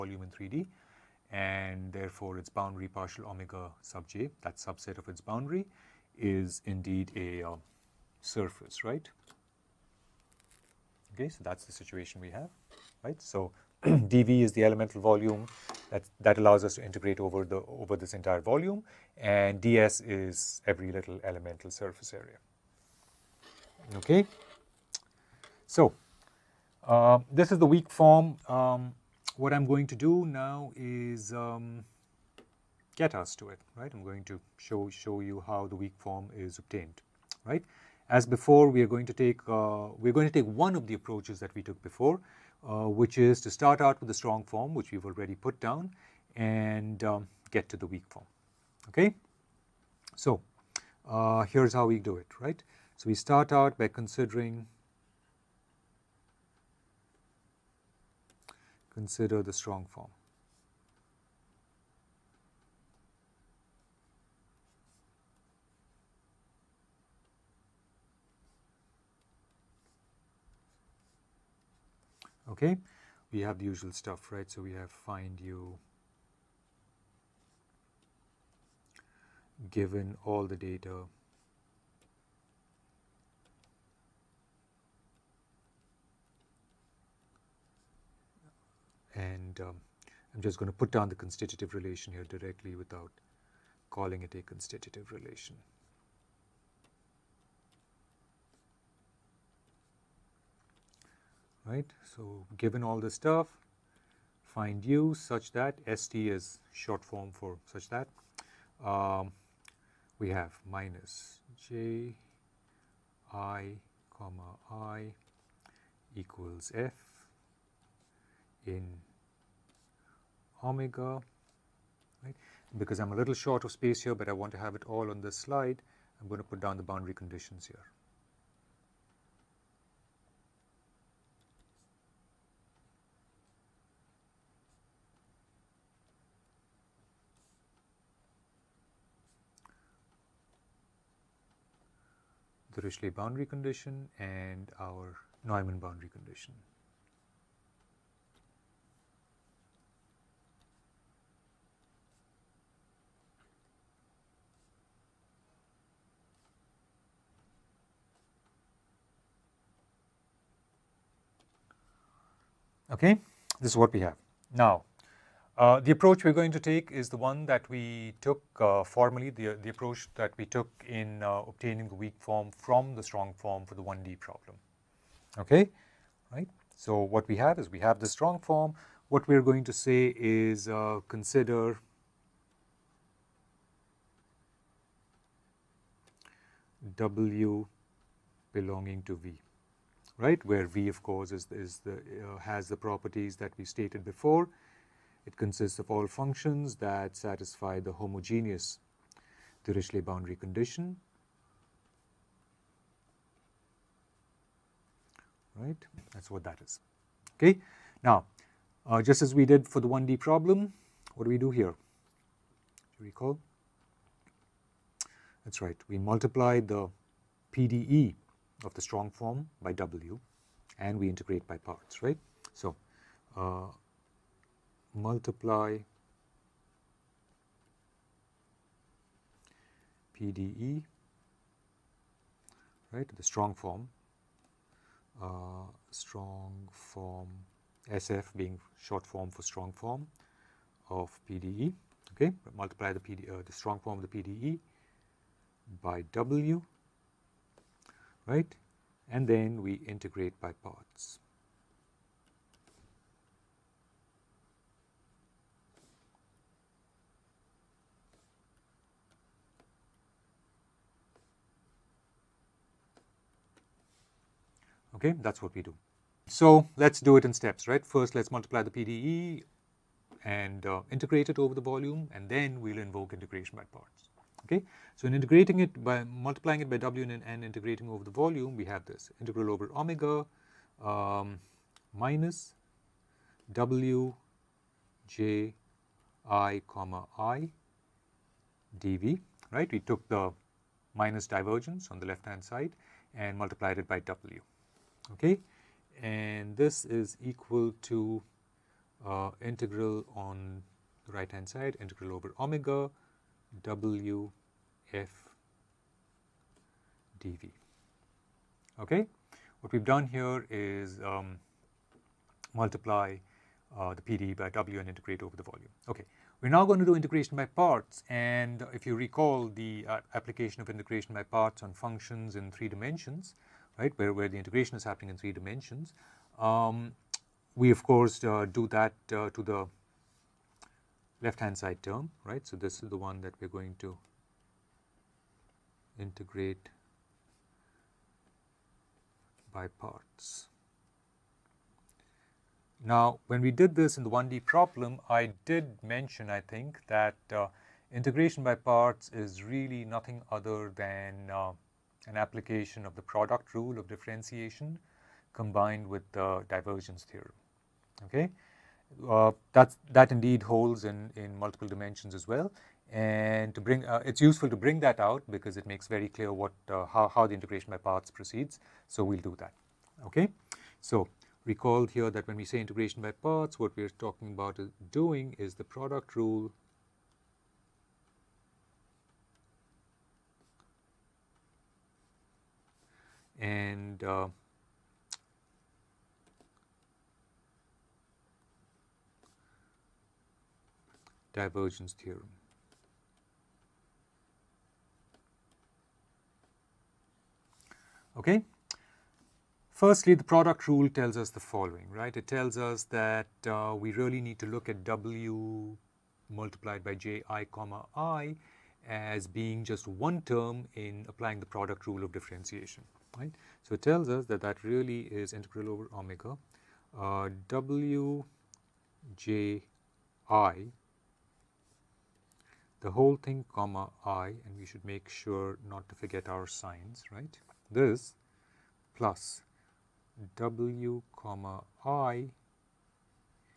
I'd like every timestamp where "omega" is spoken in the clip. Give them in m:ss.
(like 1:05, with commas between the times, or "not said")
0:03, 2:00, 4:39, 5:02, 6:55.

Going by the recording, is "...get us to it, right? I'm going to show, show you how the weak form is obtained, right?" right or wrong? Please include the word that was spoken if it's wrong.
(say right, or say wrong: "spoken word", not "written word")
right.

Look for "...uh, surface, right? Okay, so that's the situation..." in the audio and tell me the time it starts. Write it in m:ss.
0:07.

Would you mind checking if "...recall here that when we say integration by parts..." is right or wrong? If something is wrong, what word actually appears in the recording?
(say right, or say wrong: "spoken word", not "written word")
right.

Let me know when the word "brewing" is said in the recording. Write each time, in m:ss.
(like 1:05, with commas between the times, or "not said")
not said.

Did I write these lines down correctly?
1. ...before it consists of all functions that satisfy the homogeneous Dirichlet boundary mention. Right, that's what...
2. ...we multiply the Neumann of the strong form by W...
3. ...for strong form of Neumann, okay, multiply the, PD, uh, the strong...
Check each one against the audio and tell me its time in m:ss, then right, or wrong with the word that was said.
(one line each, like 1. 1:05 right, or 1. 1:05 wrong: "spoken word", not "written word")
1. 3:14 wrong: "condition", not "mention"
2. 3:35 wrong: "PDE", not "Neumann"
3. 3:59 wrong: "PDE", not "Neumann".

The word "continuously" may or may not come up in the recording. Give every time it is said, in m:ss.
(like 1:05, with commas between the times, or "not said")
not said.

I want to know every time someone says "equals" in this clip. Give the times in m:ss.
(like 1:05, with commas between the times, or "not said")
1:56, 4:57.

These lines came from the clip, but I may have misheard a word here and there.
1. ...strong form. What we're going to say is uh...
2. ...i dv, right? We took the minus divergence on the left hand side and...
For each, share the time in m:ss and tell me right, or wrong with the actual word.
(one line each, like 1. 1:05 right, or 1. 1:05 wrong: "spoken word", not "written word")
1. 2:58 right
2. 4:47 right.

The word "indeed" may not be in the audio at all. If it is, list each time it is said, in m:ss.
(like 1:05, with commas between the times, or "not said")
0:06, 6:00.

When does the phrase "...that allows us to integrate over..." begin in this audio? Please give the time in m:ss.
0:16.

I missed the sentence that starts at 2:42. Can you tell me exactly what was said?
Okay, this is what we have.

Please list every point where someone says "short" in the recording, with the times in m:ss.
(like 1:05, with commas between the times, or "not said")
1:46, 2:03, 3:58.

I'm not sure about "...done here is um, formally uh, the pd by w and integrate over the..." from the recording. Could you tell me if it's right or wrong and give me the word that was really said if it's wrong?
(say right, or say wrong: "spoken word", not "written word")
wrong: "multiply", not "formally".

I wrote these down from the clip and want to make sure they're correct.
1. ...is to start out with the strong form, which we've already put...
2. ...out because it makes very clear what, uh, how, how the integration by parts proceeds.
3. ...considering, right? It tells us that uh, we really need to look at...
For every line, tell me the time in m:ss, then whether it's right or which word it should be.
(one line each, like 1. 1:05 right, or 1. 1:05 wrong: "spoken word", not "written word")
1. 0:43 right
2. 6:04 right
3. 6:41 wrong: "following", not "considering".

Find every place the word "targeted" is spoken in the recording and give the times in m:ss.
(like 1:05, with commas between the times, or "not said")
not said.